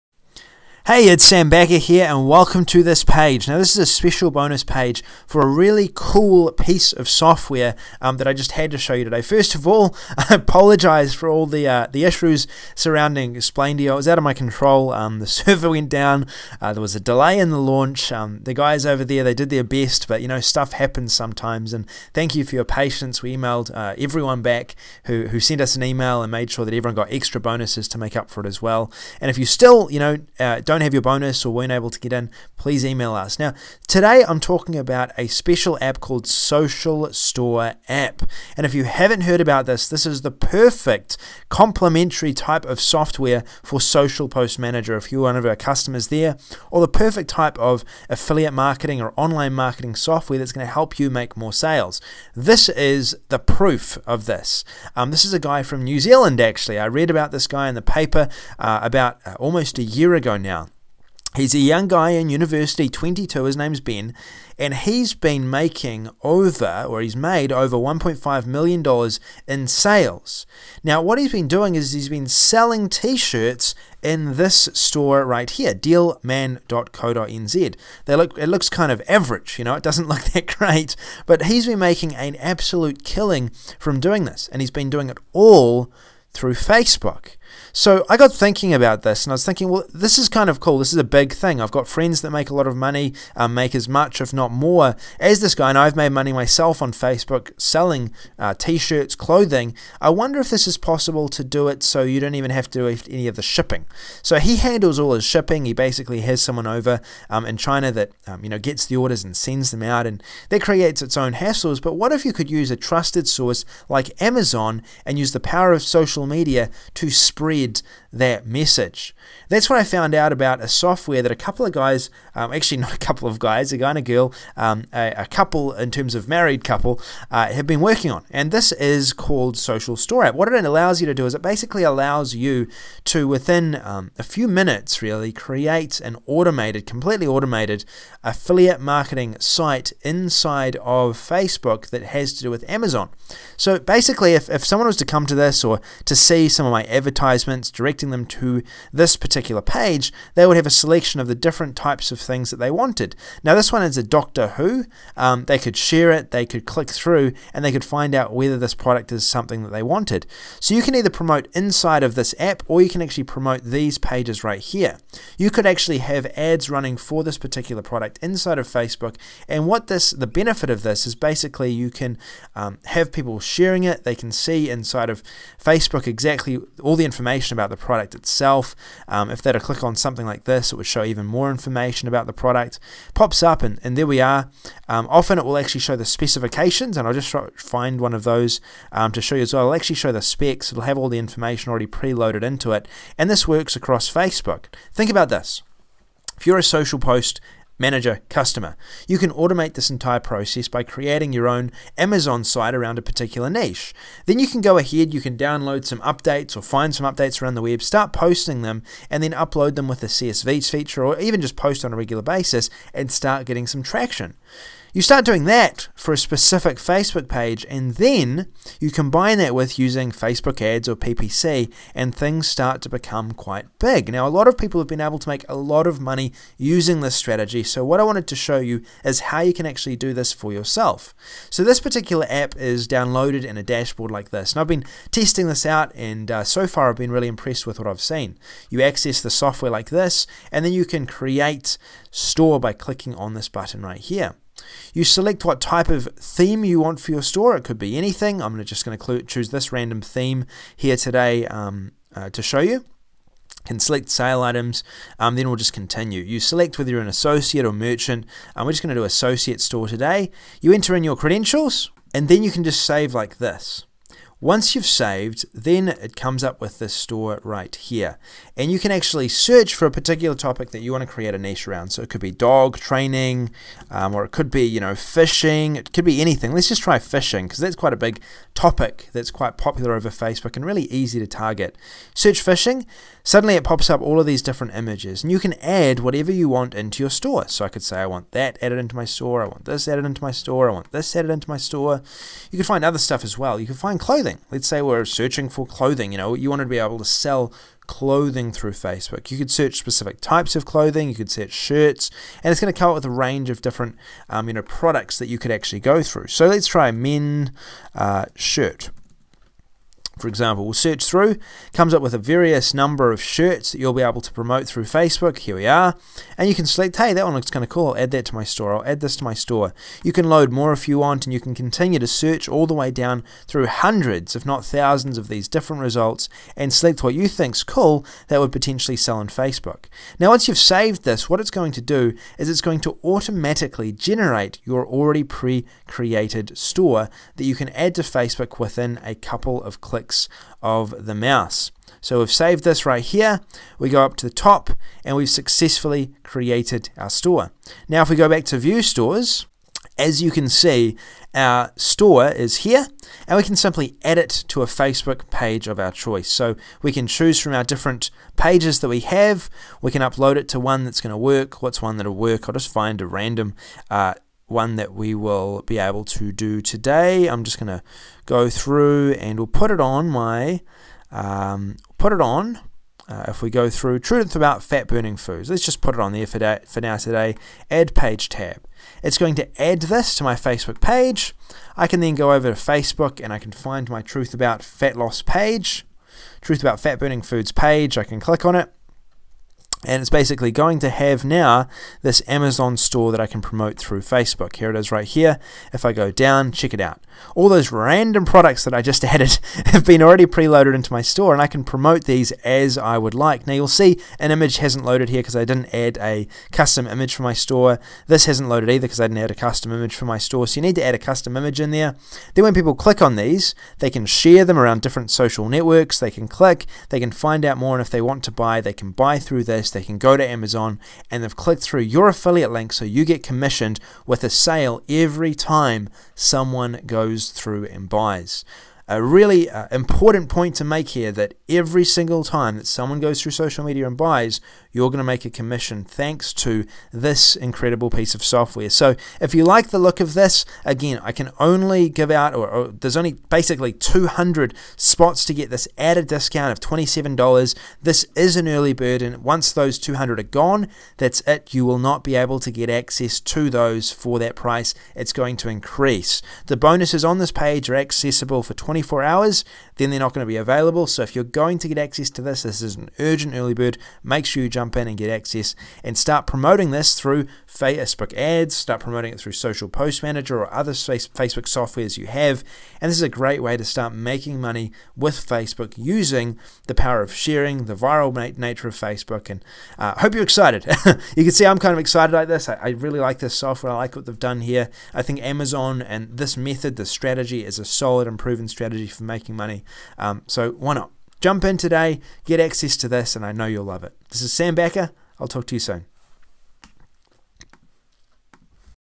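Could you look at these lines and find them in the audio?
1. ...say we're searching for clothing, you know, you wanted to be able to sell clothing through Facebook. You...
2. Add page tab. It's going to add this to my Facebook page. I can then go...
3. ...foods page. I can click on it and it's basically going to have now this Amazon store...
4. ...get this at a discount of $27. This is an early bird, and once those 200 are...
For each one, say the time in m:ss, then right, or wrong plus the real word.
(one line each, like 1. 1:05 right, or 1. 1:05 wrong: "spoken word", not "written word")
1. 4:54 right
2. 6:17 right
3. 6:27 right
4. 7:25 right.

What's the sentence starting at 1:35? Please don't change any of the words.
And I've made money myself on Facebook selling uh, t shirts, clothing.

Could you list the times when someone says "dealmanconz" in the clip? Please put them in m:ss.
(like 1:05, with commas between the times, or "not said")
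1:15.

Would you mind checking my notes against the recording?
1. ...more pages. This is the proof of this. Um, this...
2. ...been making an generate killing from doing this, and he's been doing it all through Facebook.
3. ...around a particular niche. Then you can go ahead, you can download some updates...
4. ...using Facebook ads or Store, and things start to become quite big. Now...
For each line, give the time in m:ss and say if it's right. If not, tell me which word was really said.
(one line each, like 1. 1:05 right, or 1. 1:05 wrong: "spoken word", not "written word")
1. 0:51 wrong: "sales", not "pages"
2. 1:21 wrong: "absolute", not "generate"
3. 3:22 right
4. 3:39 wrong: "PPC", not "Store".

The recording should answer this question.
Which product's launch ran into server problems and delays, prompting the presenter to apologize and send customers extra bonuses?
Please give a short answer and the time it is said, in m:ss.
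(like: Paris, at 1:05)
Explaindio, at 0:13.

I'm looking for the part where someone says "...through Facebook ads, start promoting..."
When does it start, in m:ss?
7:46.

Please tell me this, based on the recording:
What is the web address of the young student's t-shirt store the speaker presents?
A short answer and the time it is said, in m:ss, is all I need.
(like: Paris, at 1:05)
dealman.co.nz, at 1:15.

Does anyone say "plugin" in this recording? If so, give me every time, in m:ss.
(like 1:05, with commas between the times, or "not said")
not said.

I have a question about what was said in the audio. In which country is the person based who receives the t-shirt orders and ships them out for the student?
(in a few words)
China.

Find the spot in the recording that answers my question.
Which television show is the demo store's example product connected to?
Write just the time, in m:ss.
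2:34.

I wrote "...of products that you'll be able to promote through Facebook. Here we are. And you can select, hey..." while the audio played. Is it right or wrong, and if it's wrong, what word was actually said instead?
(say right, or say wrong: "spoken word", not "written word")
wrong: "shirts", not "products".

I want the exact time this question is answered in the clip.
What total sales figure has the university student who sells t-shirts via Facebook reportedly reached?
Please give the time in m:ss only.
1:07.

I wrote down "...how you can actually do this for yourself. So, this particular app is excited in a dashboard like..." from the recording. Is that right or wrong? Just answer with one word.
wrong.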